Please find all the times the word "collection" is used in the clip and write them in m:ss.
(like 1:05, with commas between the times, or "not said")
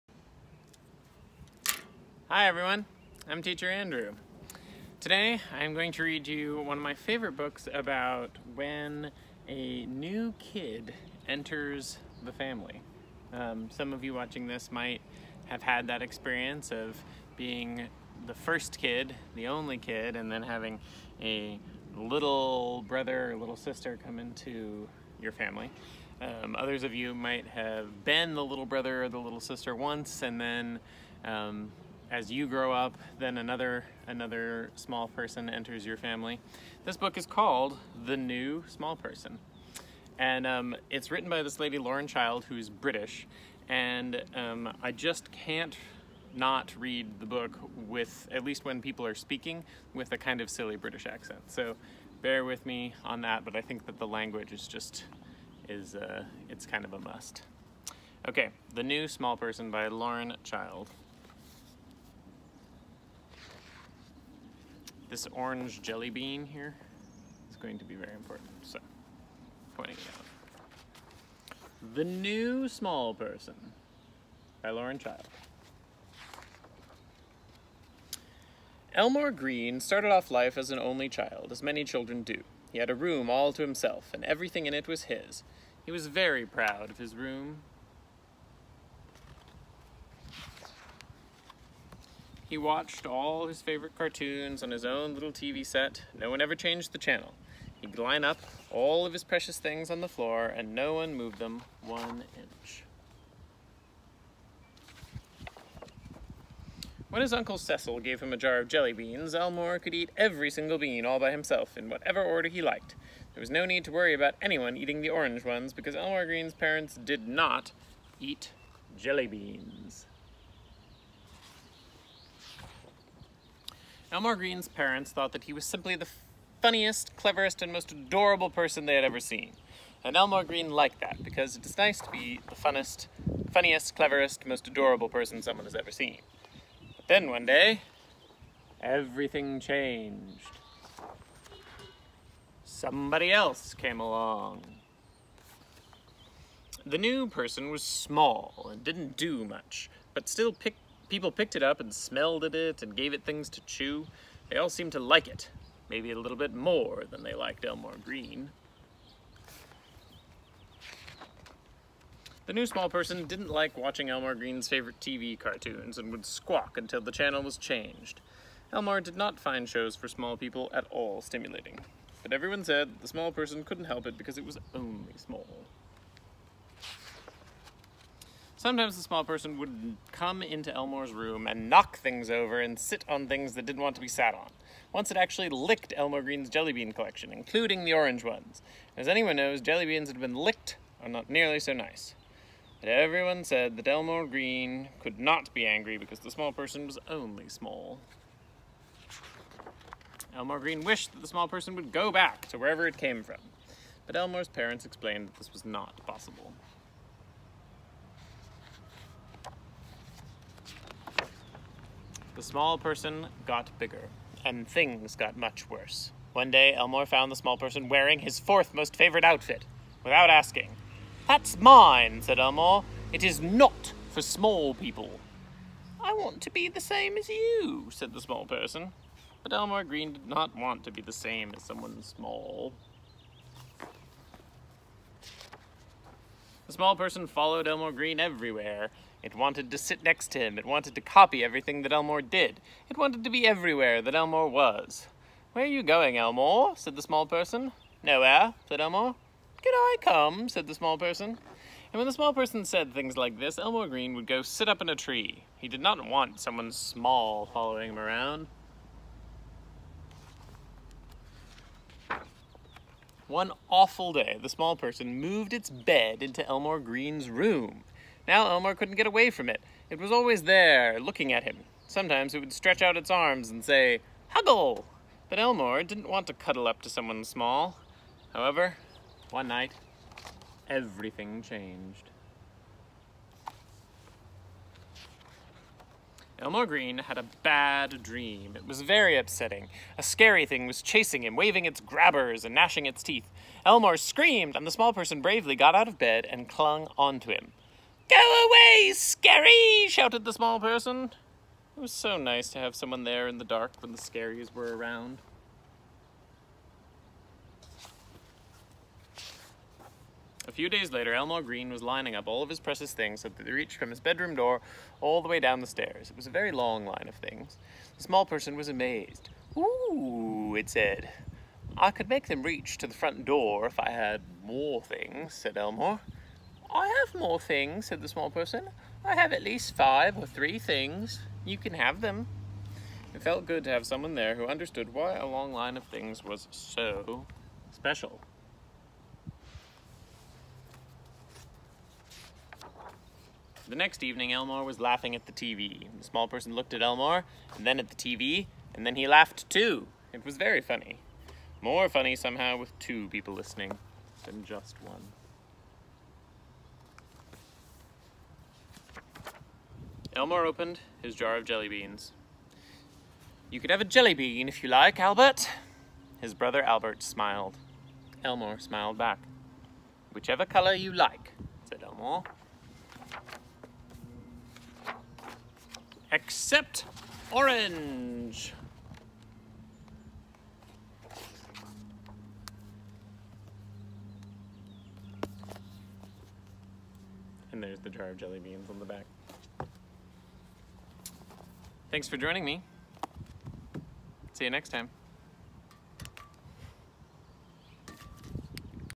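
3:06.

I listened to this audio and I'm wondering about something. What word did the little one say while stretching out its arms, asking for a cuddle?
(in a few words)
Huggle.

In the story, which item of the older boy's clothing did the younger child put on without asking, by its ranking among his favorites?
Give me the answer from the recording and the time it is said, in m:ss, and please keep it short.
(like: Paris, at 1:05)
fourth most favorite outfit, at 3:38.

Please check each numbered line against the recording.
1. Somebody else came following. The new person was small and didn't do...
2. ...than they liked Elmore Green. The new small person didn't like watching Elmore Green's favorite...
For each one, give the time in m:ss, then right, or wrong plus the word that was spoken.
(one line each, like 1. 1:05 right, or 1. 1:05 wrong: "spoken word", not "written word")
1. 2:22 wrong: "along", not "following"
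2. 2:37 right.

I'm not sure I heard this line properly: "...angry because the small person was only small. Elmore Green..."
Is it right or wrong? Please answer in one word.
right.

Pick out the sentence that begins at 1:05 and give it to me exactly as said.
this orange jelly bean here is going to be very important.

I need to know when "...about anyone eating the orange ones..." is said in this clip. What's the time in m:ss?
1:54.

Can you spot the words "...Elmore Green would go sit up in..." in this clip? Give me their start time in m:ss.
4:13.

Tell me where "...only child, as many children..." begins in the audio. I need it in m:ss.
1:20.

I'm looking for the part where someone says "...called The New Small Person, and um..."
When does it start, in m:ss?
0:37.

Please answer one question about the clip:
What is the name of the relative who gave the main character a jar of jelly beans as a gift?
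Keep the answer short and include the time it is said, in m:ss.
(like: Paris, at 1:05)
Uncle Cecil, at 1:47.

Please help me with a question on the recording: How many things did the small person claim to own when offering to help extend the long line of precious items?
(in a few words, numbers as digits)
five or three.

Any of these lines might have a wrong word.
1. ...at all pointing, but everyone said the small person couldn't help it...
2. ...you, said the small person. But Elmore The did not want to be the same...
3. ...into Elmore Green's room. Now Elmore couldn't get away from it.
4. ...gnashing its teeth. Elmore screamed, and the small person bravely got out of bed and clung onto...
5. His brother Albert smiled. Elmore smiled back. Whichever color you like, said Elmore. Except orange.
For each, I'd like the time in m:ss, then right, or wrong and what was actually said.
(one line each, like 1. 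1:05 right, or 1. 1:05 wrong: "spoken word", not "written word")
1. 2:50 wrong: "stimulating", not "pointing"
2. 3:47 wrong: "Green", not "The"
3. 4:26 right
4. 4:52 right
5. 6:06 right.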